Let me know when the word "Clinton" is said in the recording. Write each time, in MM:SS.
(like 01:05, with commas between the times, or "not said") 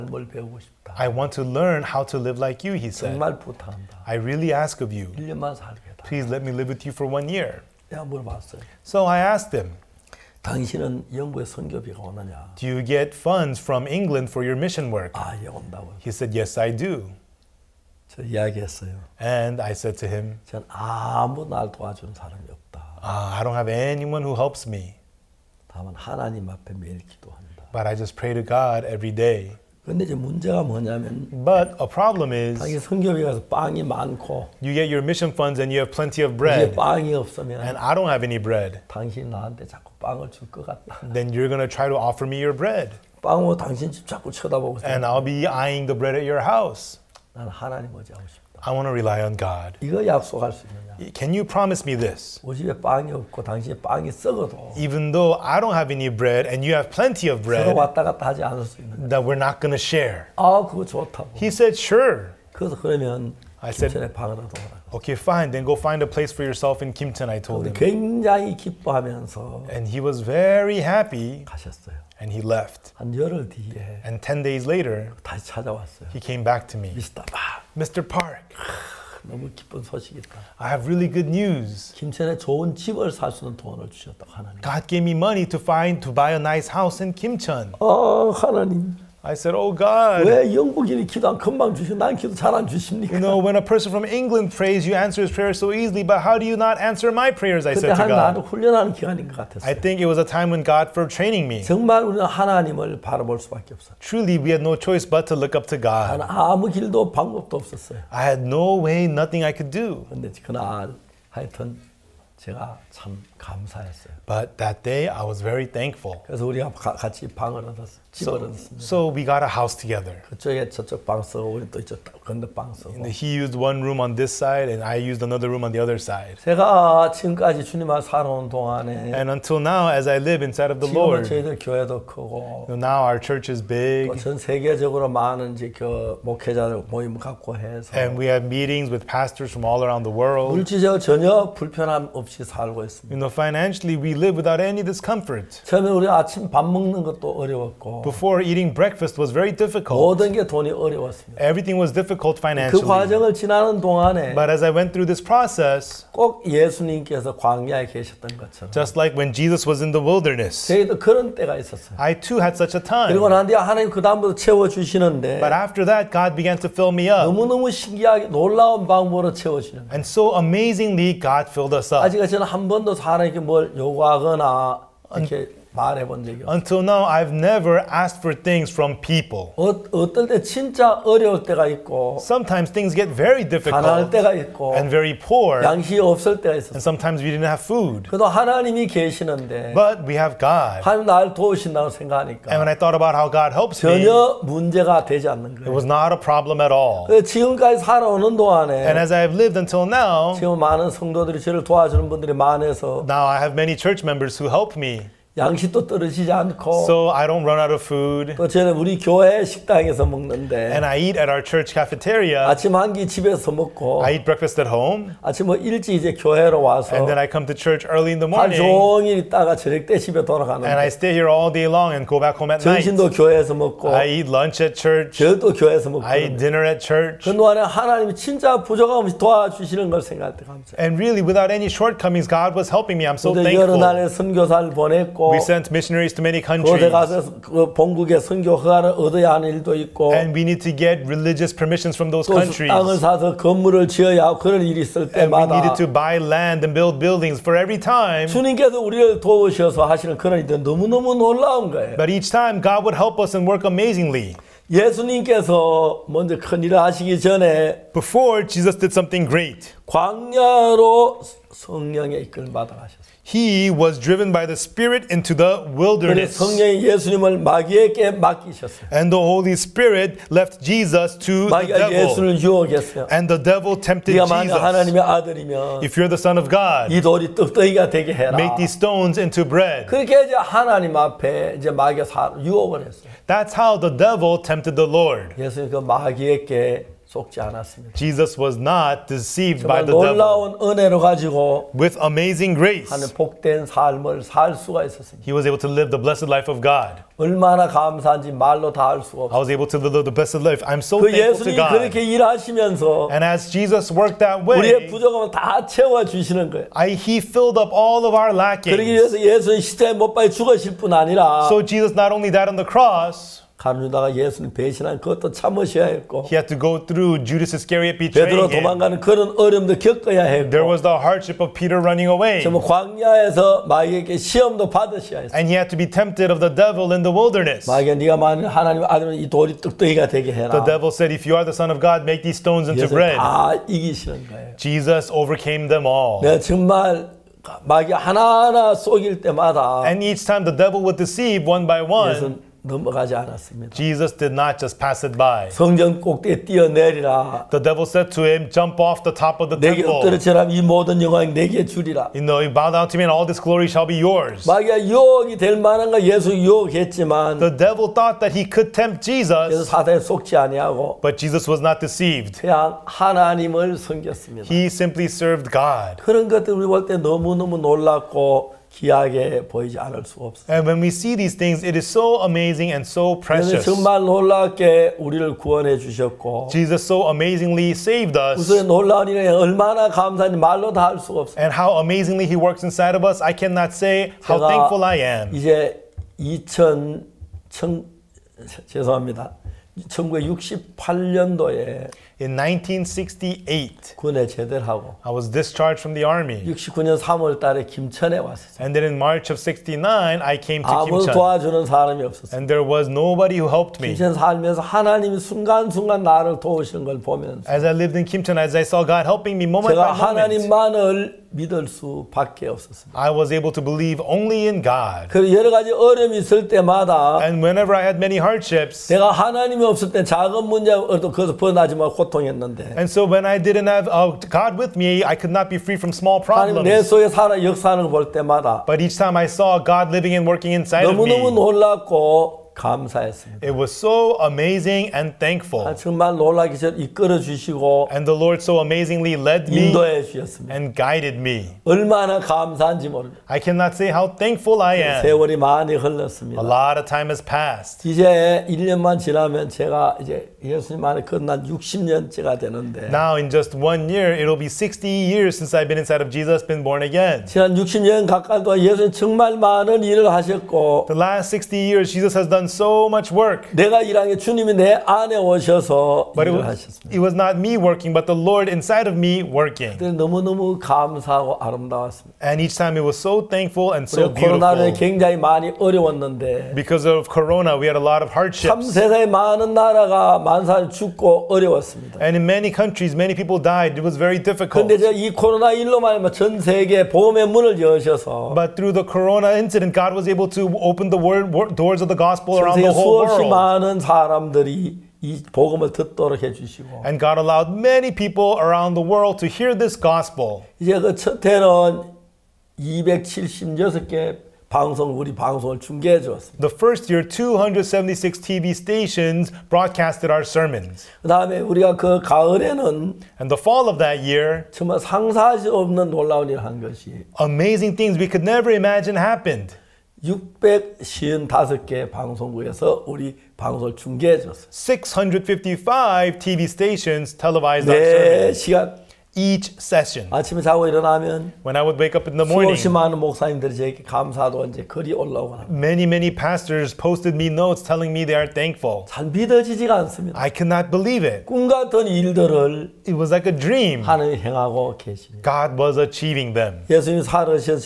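not said.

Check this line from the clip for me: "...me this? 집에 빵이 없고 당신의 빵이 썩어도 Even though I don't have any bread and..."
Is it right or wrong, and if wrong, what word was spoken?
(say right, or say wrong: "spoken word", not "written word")
right.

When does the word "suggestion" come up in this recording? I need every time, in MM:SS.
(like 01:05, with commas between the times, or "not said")
not said.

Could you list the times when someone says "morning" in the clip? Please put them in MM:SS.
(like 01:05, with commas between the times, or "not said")
03:38, 08:52.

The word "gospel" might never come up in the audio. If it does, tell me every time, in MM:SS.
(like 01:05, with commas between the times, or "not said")
08:11, 08:19.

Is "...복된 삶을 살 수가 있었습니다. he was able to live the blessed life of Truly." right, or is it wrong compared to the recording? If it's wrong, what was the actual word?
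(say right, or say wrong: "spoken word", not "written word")
wrong: "God", not "Truly".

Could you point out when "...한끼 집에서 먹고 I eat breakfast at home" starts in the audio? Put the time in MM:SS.
03:32.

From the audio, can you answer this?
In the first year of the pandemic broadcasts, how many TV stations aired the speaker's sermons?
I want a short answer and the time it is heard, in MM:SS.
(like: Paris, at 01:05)
276, at 08:27.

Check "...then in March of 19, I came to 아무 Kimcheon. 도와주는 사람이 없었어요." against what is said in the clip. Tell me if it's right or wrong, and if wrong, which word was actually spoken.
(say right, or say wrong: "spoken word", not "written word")
wrong: "69", not "19".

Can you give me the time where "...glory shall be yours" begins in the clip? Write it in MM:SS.
05:53.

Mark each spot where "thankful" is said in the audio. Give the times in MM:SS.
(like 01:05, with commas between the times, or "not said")
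01:55, 03:53, 05:01, 06:24, 07:15, 07:24, 07:53, 08:58.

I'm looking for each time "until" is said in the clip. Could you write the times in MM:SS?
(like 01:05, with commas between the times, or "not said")
02:09, 02:56, 03:19.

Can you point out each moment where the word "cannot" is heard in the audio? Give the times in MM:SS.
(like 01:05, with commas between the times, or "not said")
06:23, 07:23, 09:00.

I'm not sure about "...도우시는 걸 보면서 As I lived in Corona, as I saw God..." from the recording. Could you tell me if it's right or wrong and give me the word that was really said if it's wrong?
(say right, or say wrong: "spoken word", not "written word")
wrong: "Kimcheon", not "Corona".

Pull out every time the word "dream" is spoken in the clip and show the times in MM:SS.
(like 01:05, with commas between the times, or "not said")
09:03.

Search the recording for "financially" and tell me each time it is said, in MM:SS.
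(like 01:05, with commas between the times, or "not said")
02:23, 02:32.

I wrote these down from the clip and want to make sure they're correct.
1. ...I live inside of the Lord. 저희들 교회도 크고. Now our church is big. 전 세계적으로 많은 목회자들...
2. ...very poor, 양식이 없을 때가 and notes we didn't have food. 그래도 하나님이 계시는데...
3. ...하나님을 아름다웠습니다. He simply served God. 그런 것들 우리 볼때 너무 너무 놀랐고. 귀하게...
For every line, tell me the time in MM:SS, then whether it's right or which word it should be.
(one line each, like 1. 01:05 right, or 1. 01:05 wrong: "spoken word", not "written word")
1. 02:10 right
2. 03:04 wrong: "sometimes", not "notes"
3. 06:02 wrong: "섬겼습니다", not "아름다웠습니다".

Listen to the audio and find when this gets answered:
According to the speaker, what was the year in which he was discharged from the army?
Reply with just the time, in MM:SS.
06:32.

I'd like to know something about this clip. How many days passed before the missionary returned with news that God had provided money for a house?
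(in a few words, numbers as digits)
10.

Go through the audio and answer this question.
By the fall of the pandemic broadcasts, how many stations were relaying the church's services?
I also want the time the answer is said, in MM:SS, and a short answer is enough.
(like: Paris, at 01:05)
655, at 08:44.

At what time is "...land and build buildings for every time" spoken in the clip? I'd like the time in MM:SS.
04:06.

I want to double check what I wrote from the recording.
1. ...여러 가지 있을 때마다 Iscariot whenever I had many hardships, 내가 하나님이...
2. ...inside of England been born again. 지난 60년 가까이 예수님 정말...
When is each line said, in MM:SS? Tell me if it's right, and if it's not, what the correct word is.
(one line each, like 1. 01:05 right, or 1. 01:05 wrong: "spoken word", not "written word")
1. 06:55 wrong: "And", not "Iscariot"
2. 07:35 wrong: "Jesus", not "England".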